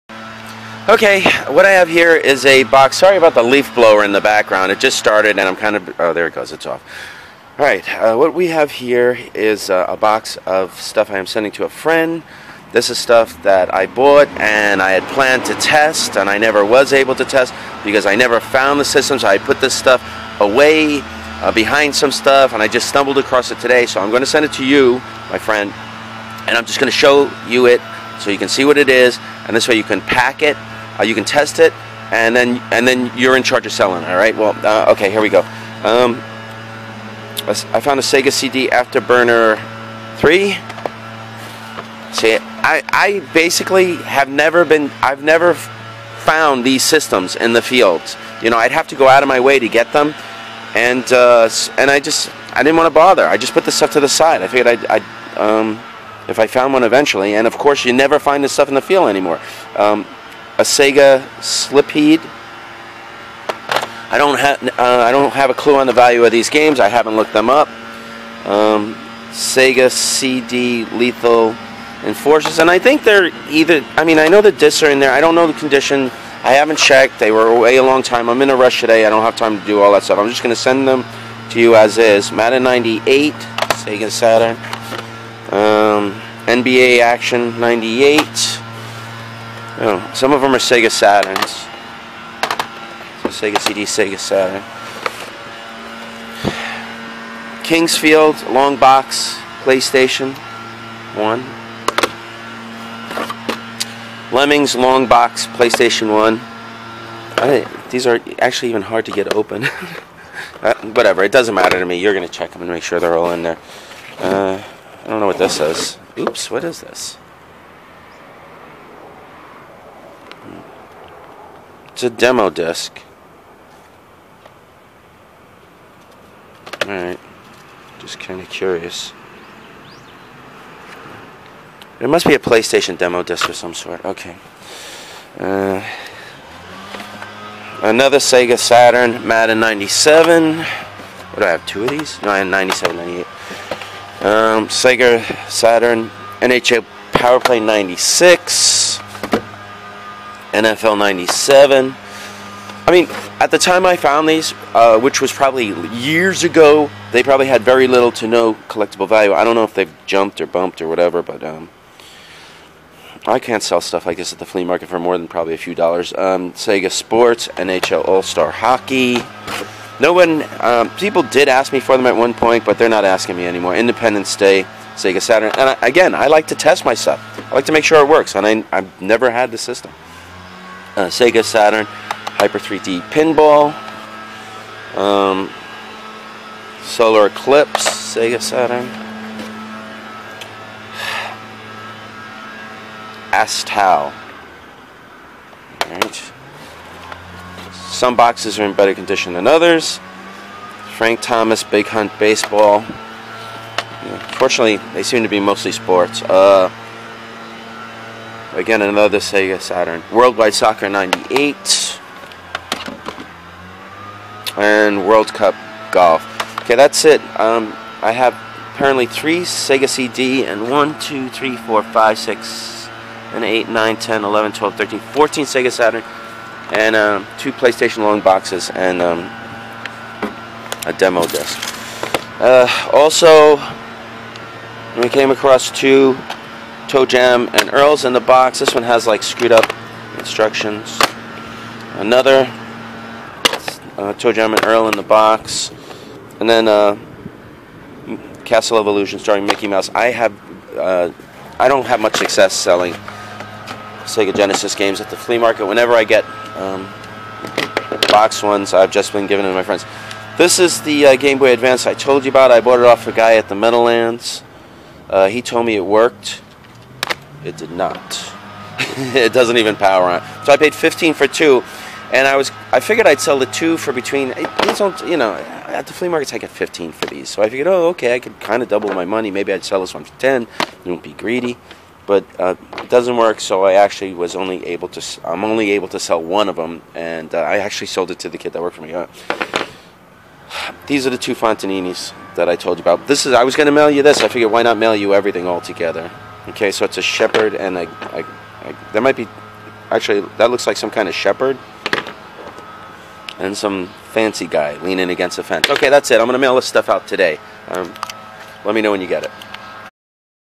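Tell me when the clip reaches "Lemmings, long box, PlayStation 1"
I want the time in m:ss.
1:44.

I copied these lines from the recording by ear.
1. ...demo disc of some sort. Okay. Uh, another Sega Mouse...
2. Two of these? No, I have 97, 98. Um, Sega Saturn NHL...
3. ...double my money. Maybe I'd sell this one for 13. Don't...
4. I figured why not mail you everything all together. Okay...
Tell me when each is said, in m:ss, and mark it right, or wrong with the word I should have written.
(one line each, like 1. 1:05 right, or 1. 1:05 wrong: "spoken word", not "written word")
1. 2:12 wrong: "Saturn", not "Mouse"
2. 2:21 right
3. 4:38 wrong: "10", not "13"
4. 4:54 right.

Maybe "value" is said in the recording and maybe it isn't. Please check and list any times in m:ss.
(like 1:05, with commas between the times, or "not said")
1:05, 2:39.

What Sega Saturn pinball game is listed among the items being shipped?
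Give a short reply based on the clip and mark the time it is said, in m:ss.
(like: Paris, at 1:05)
Hyper 3D Pinball, at 3:01.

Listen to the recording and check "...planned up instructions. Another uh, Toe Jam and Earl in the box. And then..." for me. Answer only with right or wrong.
wrong.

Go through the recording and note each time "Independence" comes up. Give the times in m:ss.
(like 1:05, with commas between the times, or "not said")
2:53.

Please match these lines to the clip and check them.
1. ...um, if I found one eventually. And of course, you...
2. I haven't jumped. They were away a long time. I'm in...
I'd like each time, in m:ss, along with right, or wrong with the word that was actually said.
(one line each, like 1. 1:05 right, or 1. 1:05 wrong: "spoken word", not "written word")
1. 0:55 right
2. 1:16 wrong: "checked", not "jumped".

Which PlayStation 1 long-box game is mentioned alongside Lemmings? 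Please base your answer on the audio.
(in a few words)
Kingsfield.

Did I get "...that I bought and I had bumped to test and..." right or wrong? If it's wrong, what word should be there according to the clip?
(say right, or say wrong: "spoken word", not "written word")
wrong: "planned", not "bumped".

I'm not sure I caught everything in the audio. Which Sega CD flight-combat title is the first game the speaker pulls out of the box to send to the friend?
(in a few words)
Afterburner 3.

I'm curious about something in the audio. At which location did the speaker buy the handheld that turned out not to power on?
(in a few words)
Meadowlands.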